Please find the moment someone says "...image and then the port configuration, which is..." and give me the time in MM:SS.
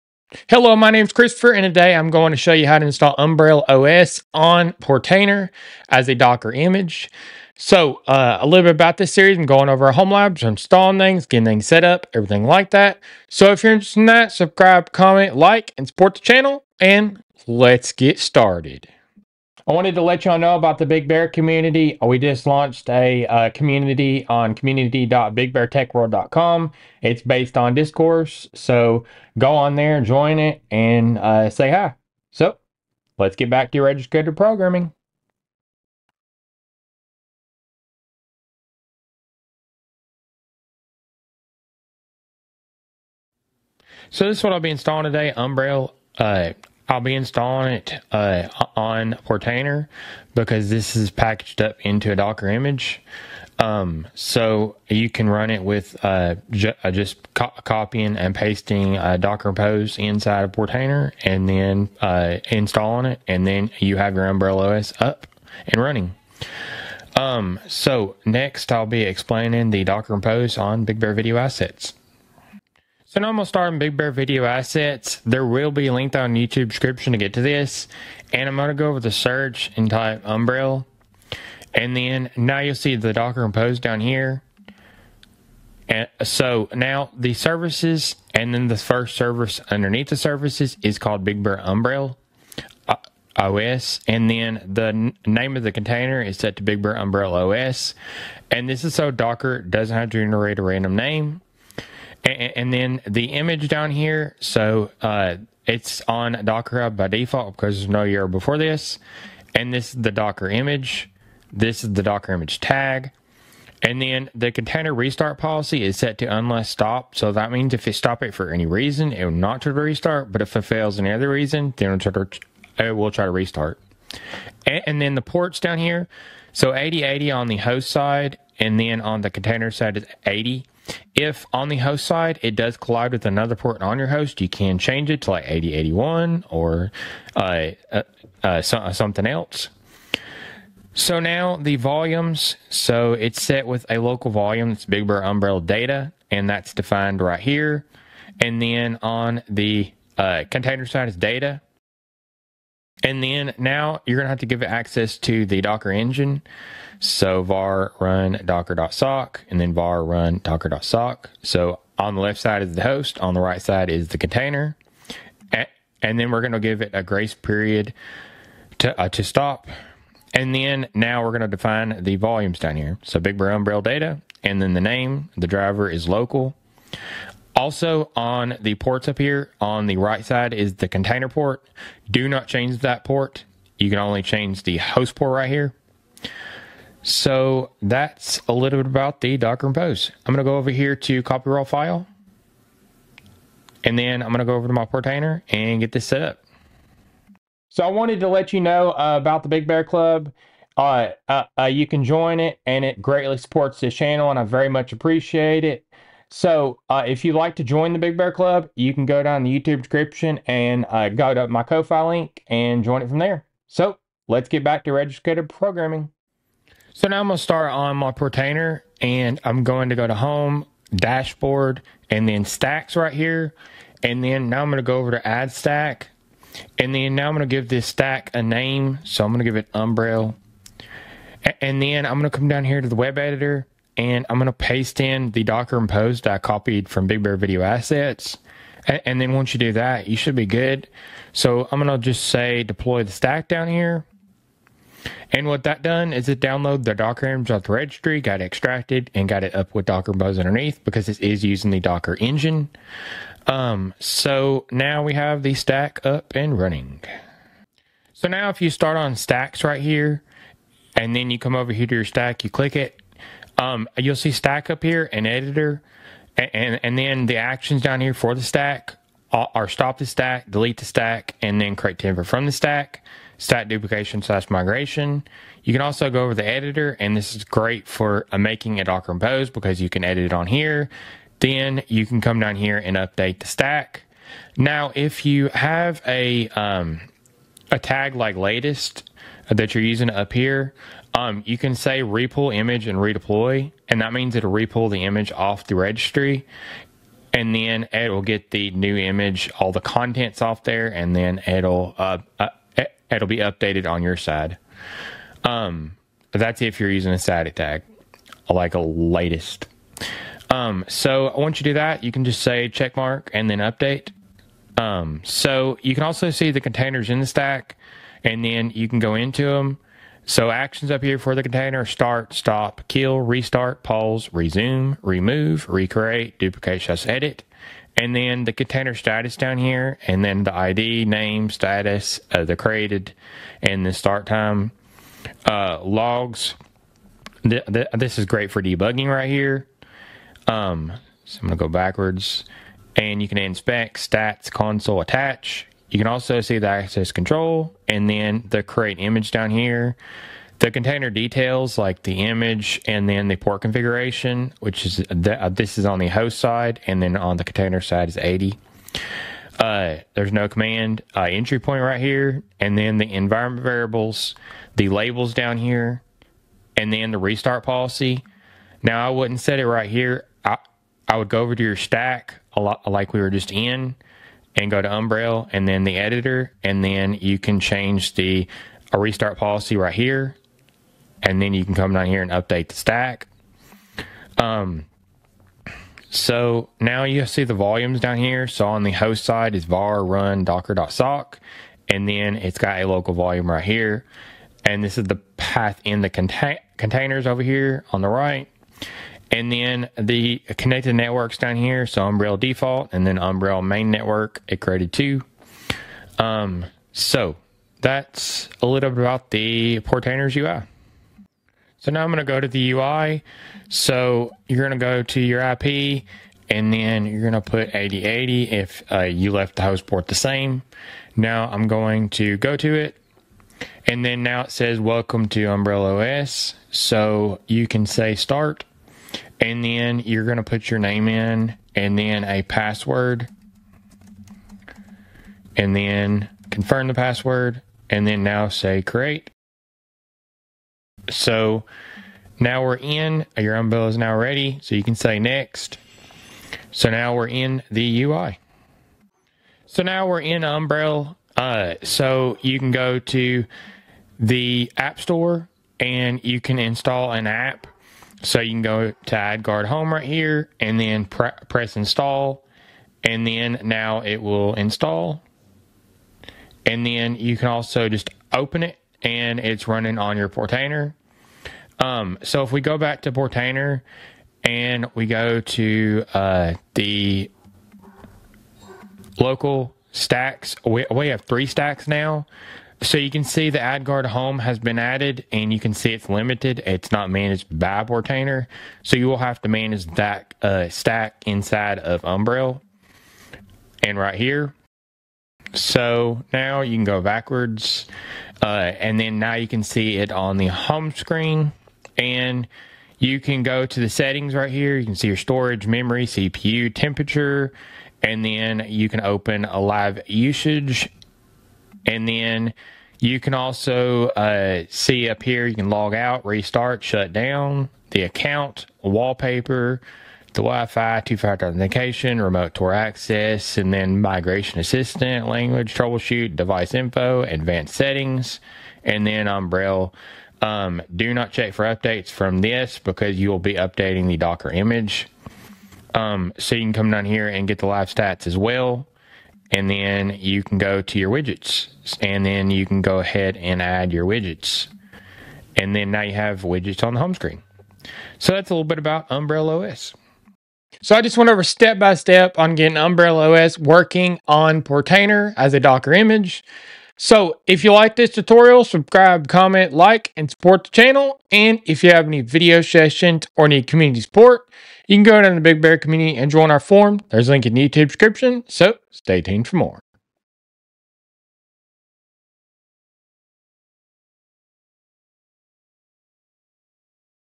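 05:52.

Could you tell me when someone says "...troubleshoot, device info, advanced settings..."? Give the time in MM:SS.
08:45.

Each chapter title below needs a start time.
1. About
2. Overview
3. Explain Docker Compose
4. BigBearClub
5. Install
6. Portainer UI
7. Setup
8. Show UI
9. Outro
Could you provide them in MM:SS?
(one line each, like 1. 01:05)
1. 00:43
2. 01:02
3. 01:12
4. 03:17
5. 03:36
6. 04:17
7. 06:51
8. 07:29
9. 09:10.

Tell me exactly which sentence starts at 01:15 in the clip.
There will be a link down YouTube description to get to this.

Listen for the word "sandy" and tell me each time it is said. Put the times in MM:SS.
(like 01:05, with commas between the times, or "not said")
not said.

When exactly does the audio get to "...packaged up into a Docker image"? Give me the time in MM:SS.
00:51.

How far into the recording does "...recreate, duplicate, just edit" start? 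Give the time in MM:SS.
05:25.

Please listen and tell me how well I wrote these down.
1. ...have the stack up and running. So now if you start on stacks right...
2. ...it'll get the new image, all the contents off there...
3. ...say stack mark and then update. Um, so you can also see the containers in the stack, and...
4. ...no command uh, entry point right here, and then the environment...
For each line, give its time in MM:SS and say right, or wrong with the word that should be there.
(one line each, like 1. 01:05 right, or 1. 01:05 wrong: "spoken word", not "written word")
1. 04:15 right
2. 04:57 right
3. 05:12 wrong: "check", not "stack"
4. 06:00 right.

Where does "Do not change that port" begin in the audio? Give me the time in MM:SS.
03:02.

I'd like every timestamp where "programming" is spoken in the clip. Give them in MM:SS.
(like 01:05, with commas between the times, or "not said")
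00:34, 03:35.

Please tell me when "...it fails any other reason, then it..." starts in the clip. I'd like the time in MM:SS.
02:00.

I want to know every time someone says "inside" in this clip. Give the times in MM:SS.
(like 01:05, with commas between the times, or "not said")
00:59, 08:11.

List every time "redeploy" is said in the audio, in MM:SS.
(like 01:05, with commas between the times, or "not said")
04:52.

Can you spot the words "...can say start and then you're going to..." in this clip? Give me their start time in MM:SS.
07:07.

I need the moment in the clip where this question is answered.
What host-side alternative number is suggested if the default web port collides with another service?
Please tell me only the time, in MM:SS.
02:15.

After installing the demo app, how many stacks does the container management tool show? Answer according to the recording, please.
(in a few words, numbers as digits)
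3.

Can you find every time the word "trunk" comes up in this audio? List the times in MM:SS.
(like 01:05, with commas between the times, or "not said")
not said.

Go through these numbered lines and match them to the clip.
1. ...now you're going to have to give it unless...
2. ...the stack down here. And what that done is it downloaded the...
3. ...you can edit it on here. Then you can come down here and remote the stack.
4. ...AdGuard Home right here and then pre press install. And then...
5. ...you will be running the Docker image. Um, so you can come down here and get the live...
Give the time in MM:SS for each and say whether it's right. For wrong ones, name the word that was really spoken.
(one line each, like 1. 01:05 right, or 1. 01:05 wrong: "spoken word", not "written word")
1. 02:33 wrong: "access", not "unless"
2. 04:03 right
3. 04:39 wrong: "update", not "remote"
4. 07:39 right
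5. 08:53 wrong: "updating", not "running".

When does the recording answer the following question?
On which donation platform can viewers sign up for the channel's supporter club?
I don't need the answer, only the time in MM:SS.
03:31.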